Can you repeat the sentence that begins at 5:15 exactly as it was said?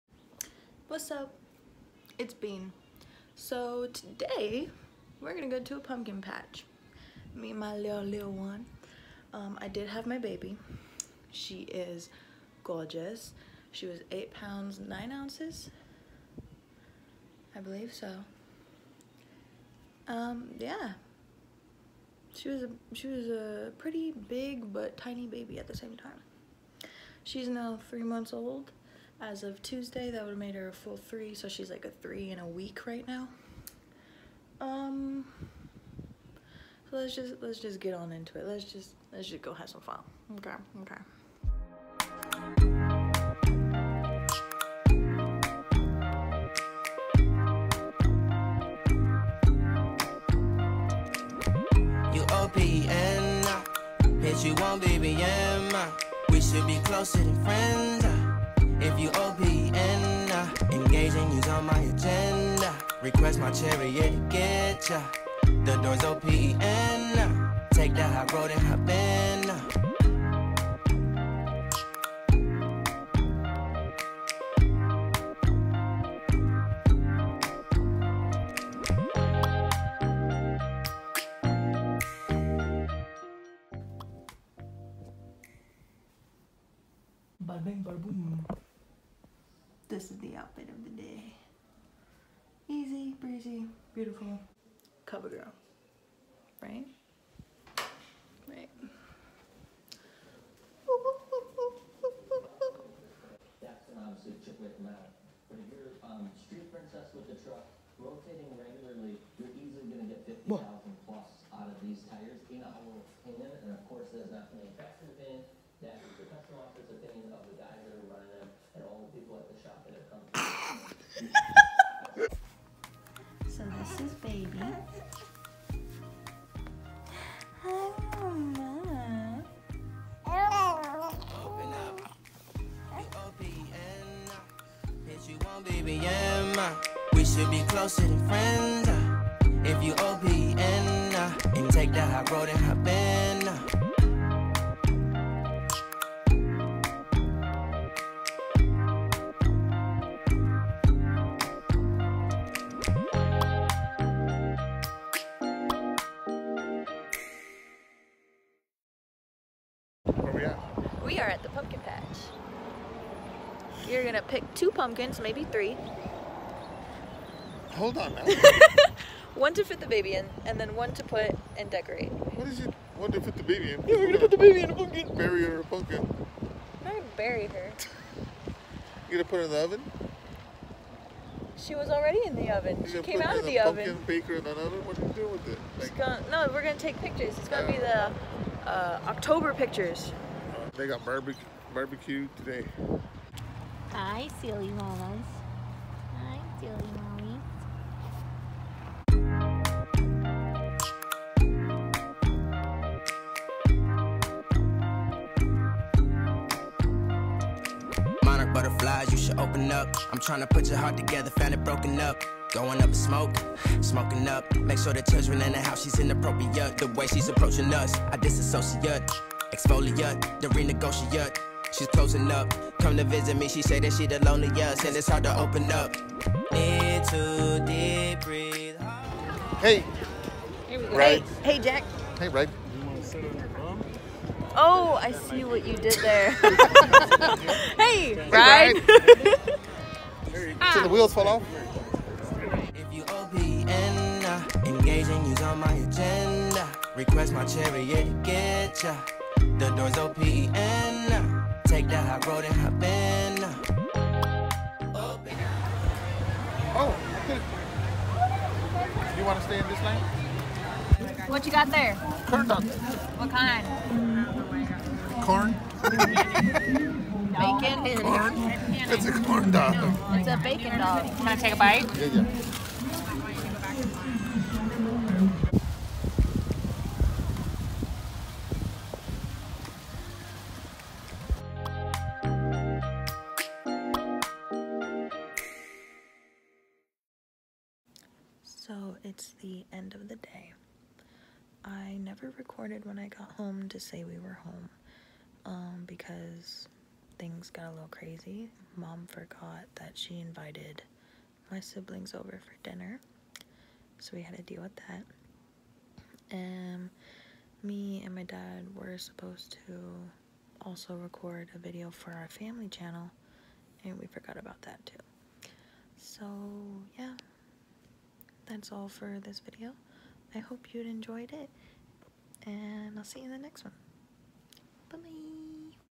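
So that's all for this video.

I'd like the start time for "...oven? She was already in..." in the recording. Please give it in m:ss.
2:59.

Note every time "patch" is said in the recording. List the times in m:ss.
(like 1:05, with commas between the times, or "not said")
0:06, 2:41.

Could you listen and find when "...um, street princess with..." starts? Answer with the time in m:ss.
1:46.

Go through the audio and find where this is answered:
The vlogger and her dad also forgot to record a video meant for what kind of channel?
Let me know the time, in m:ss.
5:12.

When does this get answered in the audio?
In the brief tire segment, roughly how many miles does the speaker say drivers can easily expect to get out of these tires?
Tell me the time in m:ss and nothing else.
1:50.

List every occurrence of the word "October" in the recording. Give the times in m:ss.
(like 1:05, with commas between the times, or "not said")
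3:09.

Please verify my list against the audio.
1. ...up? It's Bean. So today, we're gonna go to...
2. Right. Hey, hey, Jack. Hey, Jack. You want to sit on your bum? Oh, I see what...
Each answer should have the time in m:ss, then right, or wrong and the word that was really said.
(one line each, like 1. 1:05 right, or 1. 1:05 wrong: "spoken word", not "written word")
1. 0:01 right
2. 3:50 wrong: "Red", not "Jack".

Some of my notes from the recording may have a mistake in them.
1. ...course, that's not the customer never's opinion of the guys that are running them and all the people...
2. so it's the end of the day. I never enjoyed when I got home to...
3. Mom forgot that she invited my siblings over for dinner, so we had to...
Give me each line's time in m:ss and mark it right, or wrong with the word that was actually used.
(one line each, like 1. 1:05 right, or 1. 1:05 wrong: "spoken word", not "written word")
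1. 1:53 wrong: "officer", not "never"
2. 4:48 wrong: "recorded", not "enjoyed"
3. 4:58 right.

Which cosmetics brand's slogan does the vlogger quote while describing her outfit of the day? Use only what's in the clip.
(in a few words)
CoverGirl.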